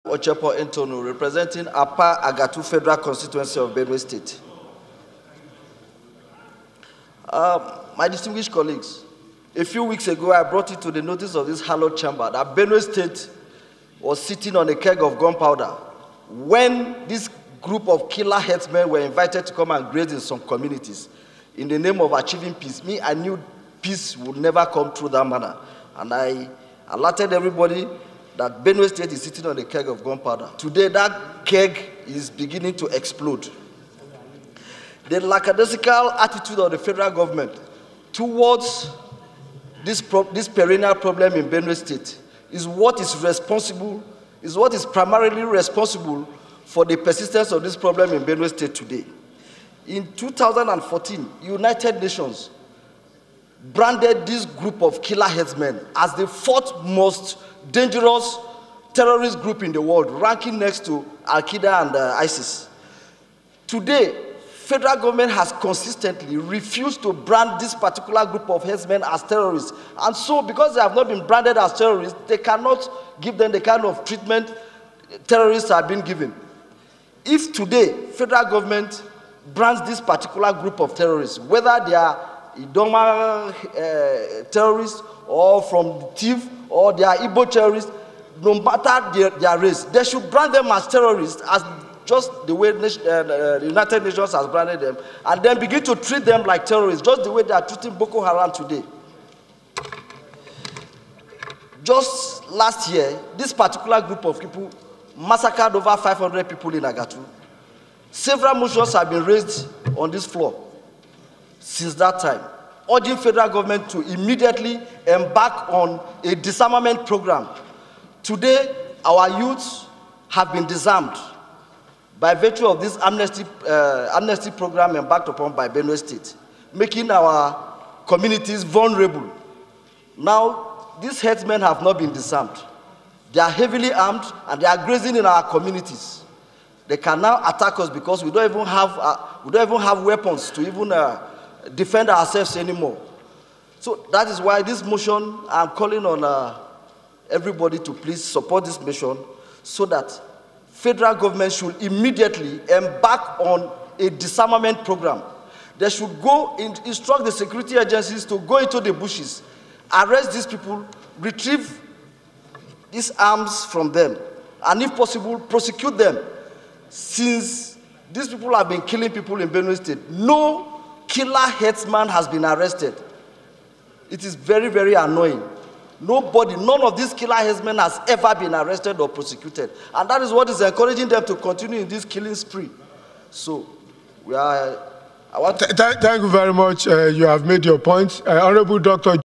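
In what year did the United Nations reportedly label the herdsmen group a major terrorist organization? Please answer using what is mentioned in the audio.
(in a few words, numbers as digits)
2014.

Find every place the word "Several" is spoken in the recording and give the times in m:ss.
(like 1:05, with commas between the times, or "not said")
1:48.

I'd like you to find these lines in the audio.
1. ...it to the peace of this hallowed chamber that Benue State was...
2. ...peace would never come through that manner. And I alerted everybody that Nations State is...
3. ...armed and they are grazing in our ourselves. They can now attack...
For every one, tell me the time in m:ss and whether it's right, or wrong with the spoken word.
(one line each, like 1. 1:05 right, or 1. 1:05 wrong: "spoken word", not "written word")
1. 0:10 wrong: "notice", not "peace"
2. 0:23 wrong: "Benue", not "Nations"
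3. 2:13 wrong: "communities", not "ourselves".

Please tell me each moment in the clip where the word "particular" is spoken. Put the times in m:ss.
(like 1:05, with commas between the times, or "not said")
1:07, 1:20, 1:43.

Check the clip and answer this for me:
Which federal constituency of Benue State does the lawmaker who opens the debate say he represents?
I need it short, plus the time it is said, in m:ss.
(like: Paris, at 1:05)
Apa Agatu, at 0:01.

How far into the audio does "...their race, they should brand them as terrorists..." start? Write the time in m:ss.
1:29.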